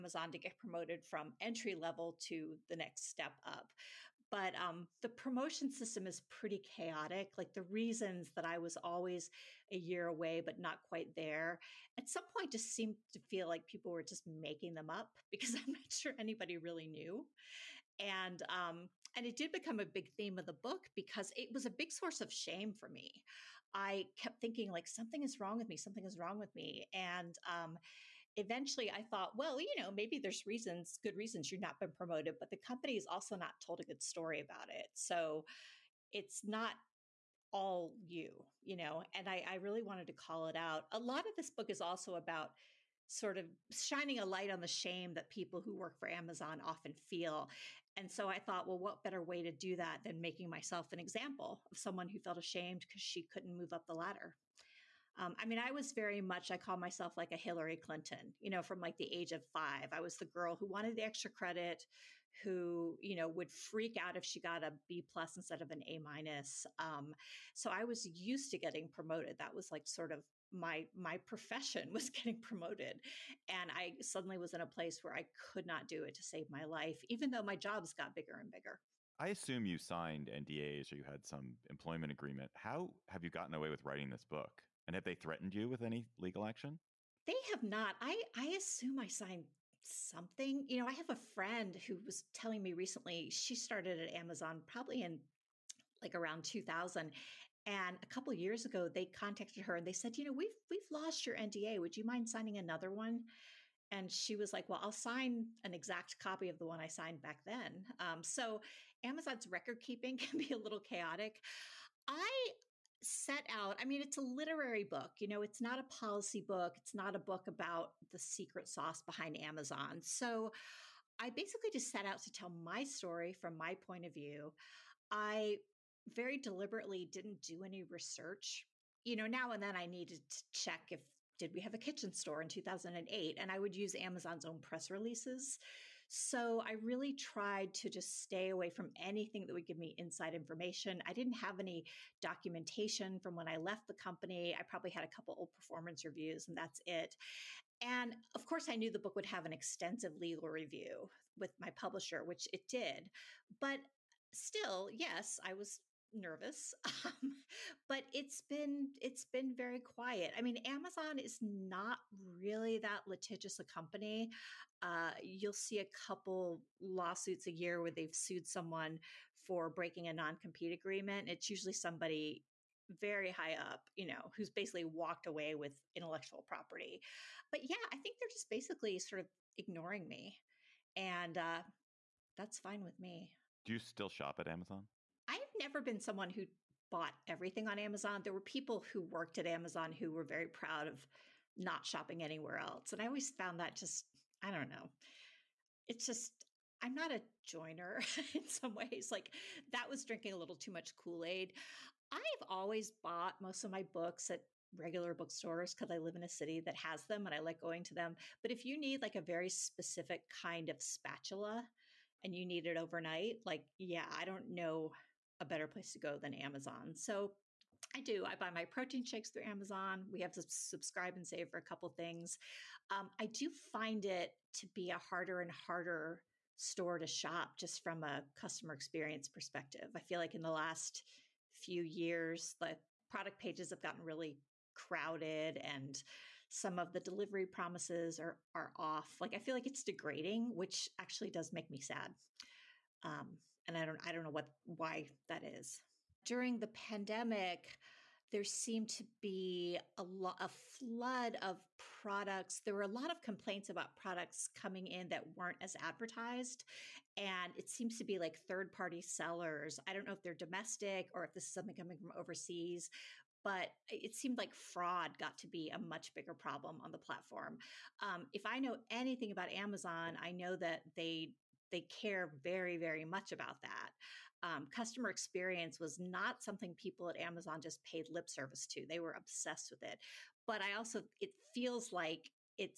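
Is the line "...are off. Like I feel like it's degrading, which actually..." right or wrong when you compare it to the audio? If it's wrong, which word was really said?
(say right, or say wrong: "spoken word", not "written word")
right.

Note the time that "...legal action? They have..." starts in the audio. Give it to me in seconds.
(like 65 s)
86 s.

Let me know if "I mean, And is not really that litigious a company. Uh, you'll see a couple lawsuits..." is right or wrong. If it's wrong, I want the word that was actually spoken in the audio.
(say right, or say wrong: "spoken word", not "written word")
wrong: "Amazon", not "And".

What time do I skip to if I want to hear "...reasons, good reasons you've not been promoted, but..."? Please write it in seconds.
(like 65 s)
30 s.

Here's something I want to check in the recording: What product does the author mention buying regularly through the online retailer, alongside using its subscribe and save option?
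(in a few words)
protein shakes.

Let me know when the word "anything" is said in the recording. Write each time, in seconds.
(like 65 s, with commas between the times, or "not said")
138 s, 268 s.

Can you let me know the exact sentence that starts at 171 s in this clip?
It's usually somebody very high up, you know, who's basically walked away with intellectual property.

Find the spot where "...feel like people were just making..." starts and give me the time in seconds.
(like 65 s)
13 s.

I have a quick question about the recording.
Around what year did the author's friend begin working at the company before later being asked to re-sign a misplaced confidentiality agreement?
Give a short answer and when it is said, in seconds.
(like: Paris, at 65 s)
2000, at 96 s.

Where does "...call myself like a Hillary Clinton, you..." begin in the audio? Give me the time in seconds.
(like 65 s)
56 s.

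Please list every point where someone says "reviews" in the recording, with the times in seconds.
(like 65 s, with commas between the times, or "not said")
146 s, 150 s.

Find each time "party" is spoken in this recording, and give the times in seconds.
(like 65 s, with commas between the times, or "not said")
258 s.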